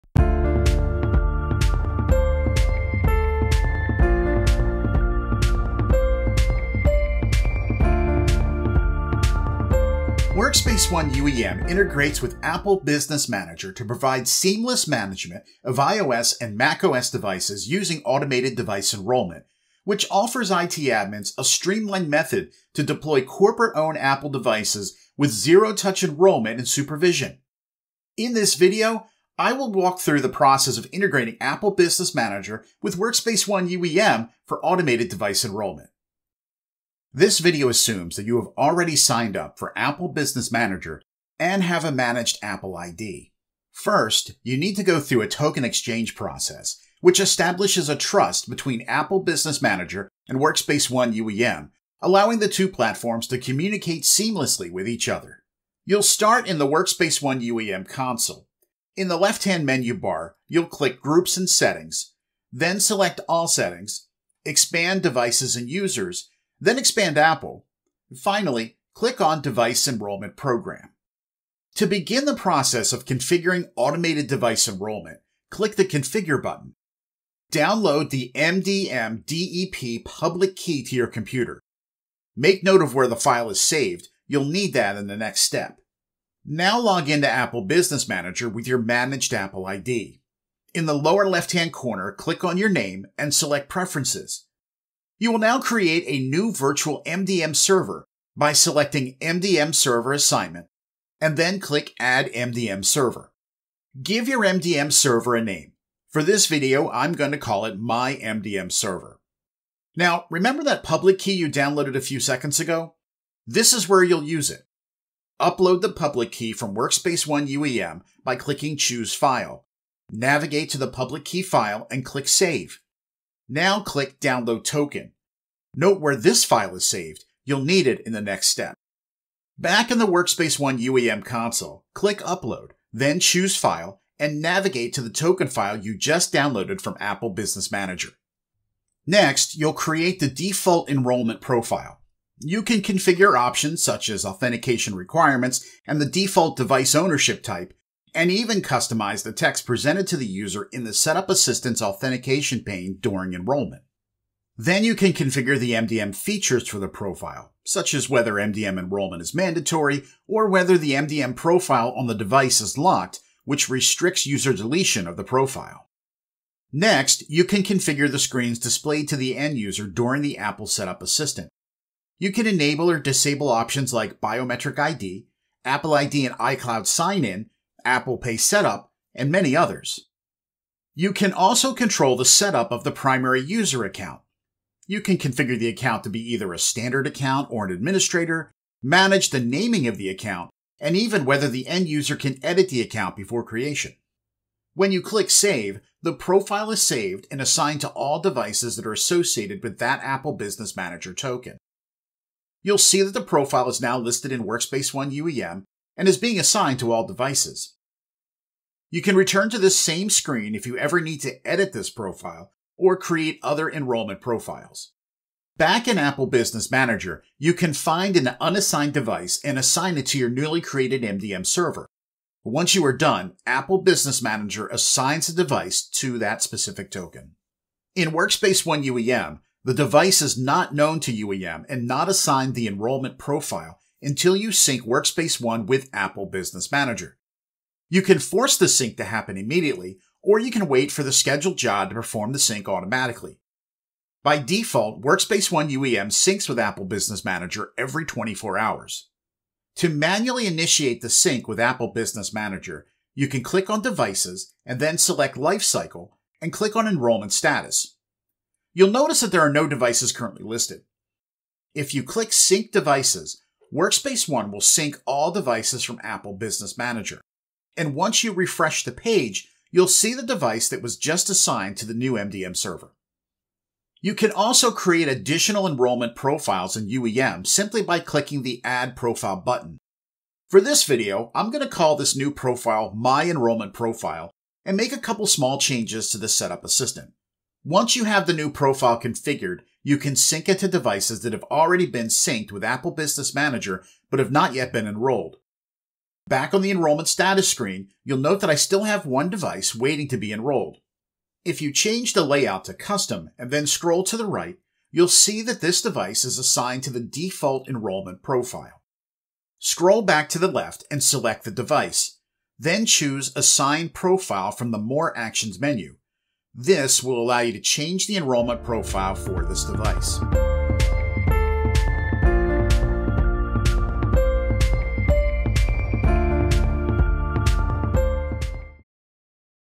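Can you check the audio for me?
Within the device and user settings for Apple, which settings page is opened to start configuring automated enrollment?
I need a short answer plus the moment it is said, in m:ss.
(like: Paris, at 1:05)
Device Enrollment Program, at 1:09.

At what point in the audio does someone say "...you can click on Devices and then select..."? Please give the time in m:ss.
4:13.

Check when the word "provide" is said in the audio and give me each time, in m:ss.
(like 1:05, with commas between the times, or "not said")
0:13.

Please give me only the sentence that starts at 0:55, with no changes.
You'll start in the Workspace ONE UEM console.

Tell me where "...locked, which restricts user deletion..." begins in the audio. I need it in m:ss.
2:42.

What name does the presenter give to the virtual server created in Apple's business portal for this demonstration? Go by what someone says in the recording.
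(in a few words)
My MDM Server.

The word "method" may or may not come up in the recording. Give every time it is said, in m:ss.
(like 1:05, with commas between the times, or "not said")
0:22.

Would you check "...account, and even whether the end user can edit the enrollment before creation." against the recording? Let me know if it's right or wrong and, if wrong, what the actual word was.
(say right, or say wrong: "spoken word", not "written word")
wrong: "account", not "enrollment".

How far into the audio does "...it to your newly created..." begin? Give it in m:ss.
3:39.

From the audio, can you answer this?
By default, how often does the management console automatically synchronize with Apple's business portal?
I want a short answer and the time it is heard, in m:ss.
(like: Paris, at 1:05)
Every 24 hours, at 4:07.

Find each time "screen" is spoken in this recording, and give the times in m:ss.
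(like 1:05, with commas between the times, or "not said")
2:48, 3:30, 4:57.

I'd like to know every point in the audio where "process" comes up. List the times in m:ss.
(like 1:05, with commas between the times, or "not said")
0:30, 0:46, 1:12.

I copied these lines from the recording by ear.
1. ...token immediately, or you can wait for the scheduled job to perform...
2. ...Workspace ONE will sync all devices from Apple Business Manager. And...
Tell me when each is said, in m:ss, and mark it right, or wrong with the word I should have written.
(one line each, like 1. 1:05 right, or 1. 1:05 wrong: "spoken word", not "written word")
1. 3:59 wrong: "happen", not "token"
2. 4:23 right.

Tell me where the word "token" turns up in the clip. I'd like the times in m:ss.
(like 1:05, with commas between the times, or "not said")
0:45, 2:04, 2:15, 3:21, 3:46.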